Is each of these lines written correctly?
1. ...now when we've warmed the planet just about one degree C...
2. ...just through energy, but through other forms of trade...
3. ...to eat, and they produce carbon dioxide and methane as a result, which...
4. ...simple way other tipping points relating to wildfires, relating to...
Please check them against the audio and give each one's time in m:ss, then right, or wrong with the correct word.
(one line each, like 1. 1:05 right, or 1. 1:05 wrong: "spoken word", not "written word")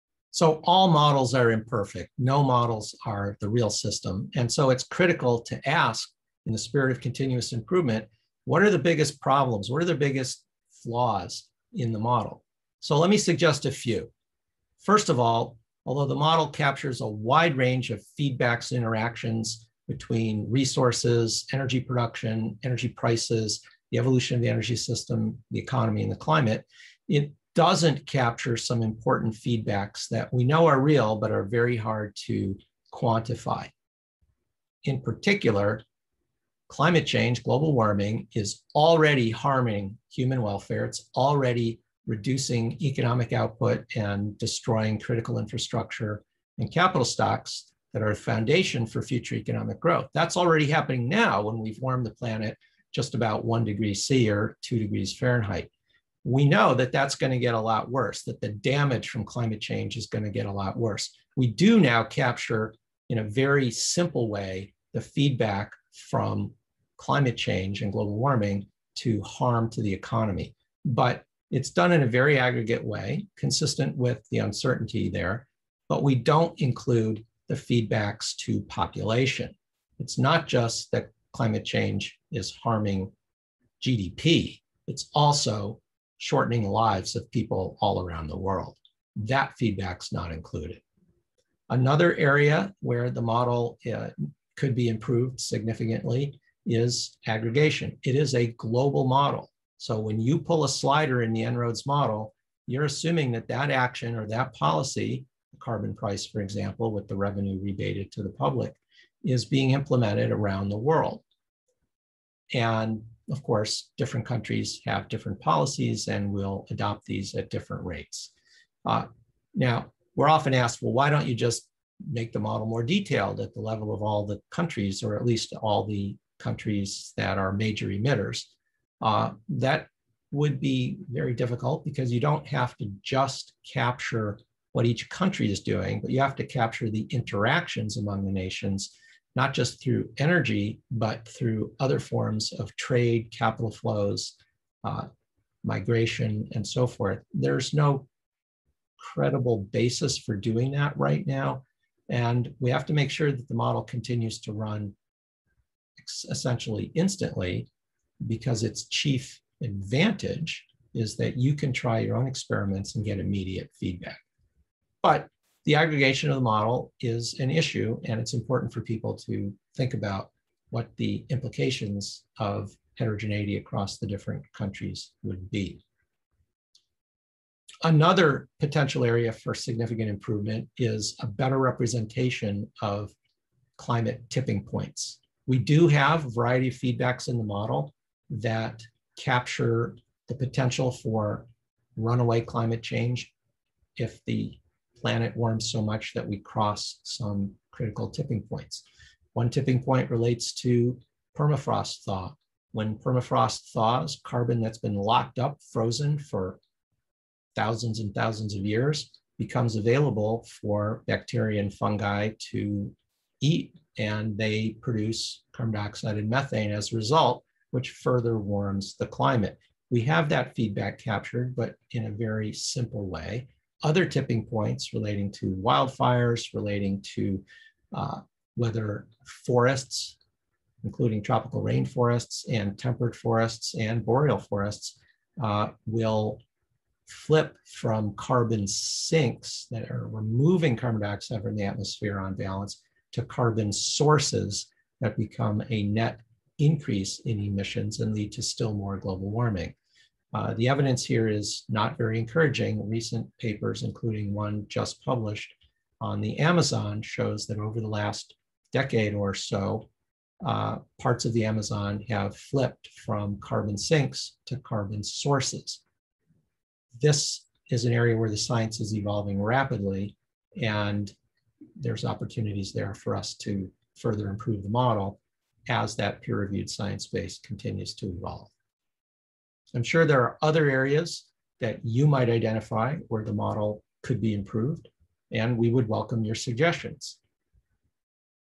1. 0:51 right
2. 2:19 right
3. 3:32 right
4. 3:42 right.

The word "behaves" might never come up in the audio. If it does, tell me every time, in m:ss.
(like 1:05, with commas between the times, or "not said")
not said.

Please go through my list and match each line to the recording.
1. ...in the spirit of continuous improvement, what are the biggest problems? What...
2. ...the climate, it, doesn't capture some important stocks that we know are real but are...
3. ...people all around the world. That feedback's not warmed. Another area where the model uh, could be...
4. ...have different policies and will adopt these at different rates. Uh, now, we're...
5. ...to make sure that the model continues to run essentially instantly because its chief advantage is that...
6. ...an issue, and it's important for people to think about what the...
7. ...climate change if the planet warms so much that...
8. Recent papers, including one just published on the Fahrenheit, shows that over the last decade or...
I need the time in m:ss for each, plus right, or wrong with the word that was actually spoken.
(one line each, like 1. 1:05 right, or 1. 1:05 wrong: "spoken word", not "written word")
1. 0:06 right
2. 0:26 wrong: "feedbacks", not "stocks"
3. 1:27 wrong: "included", not "warmed"
4. 1:54 right
5. 2:32 right
6. 2:47 right
7. 3:12 right
8. 4:12 wrong: "Amazon", not "Fahrenheit".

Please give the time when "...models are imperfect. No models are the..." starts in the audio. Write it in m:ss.
0:00.